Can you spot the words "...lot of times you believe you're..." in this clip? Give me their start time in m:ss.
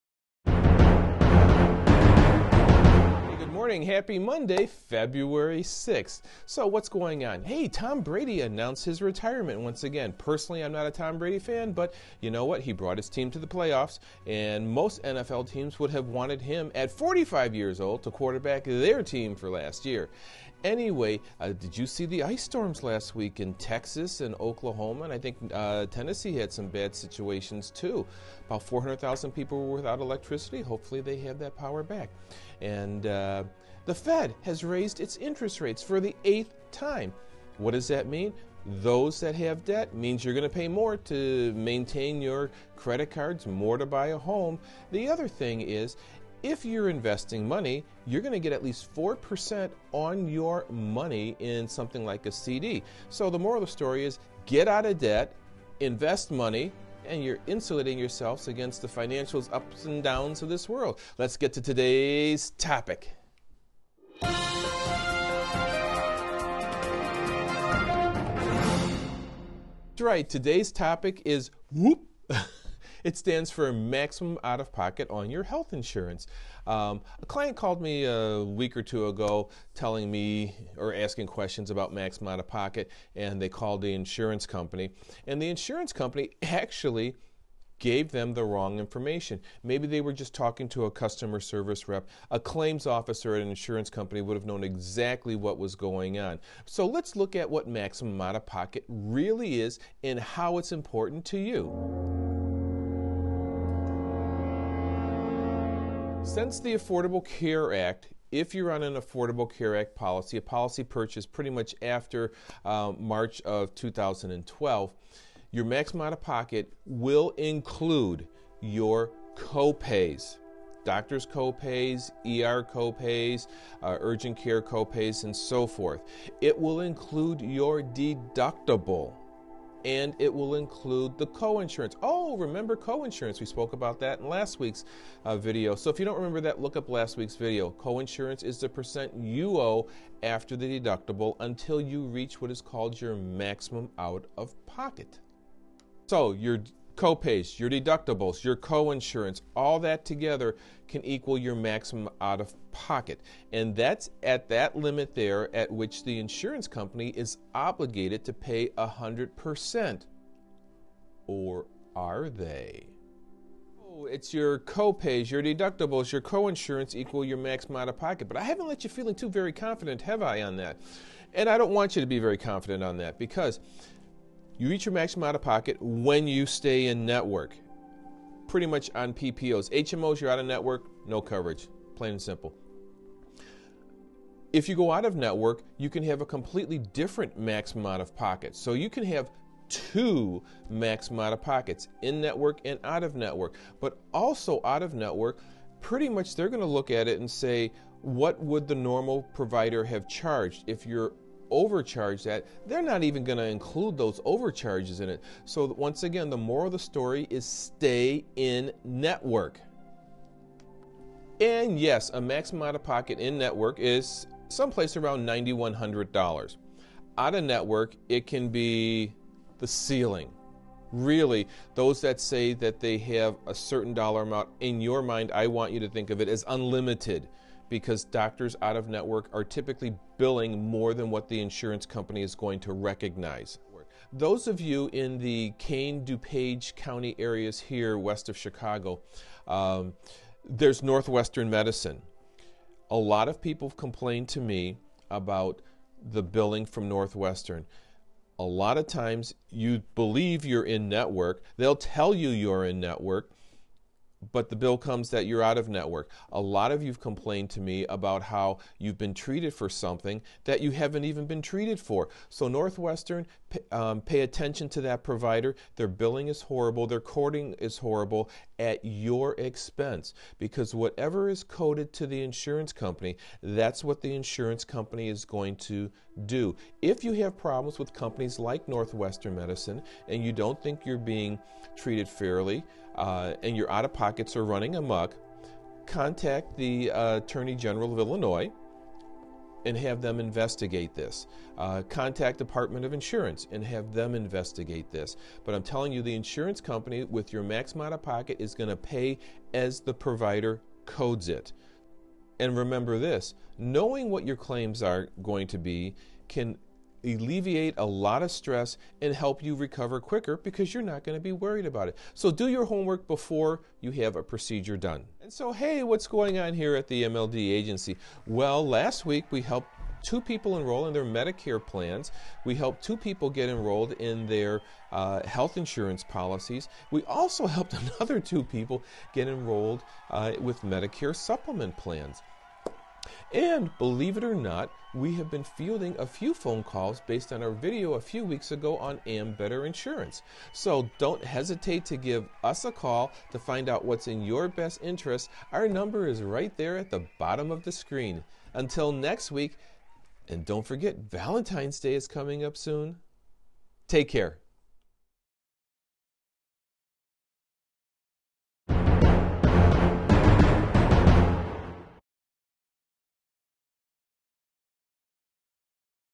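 4:08.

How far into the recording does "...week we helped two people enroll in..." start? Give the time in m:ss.
5:19.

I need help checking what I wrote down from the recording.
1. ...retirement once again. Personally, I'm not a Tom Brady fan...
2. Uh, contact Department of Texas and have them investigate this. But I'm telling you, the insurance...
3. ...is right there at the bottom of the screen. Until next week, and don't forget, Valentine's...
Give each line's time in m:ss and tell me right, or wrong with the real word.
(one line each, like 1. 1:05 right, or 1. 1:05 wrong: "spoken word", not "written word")
1. 0:09 right
2. 4:51 wrong: "Insurance", not "Texas"
3. 5:46 right.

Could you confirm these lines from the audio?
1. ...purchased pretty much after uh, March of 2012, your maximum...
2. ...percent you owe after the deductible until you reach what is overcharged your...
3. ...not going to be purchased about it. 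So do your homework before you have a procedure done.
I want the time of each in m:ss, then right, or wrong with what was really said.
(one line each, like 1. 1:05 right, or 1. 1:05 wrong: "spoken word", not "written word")
1. 1:50 right
2. 2:18 wrong: "called", not "overcharged"
3. 5:10 wrong: "worried", not "purchased".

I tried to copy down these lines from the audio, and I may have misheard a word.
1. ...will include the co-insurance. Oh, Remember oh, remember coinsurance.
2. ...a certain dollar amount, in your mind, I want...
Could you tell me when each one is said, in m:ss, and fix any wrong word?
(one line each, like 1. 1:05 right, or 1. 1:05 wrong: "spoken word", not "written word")
1. 2:10 right
2. 3:43 right.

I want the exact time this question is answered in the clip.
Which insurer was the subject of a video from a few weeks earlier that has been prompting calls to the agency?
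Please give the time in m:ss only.
5:39.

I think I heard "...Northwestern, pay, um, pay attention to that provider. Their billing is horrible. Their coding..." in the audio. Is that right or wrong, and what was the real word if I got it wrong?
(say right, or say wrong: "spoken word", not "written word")
right.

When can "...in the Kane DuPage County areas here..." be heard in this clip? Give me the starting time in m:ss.
3:54.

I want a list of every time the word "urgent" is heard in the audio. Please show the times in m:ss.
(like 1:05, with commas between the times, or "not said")
2:03.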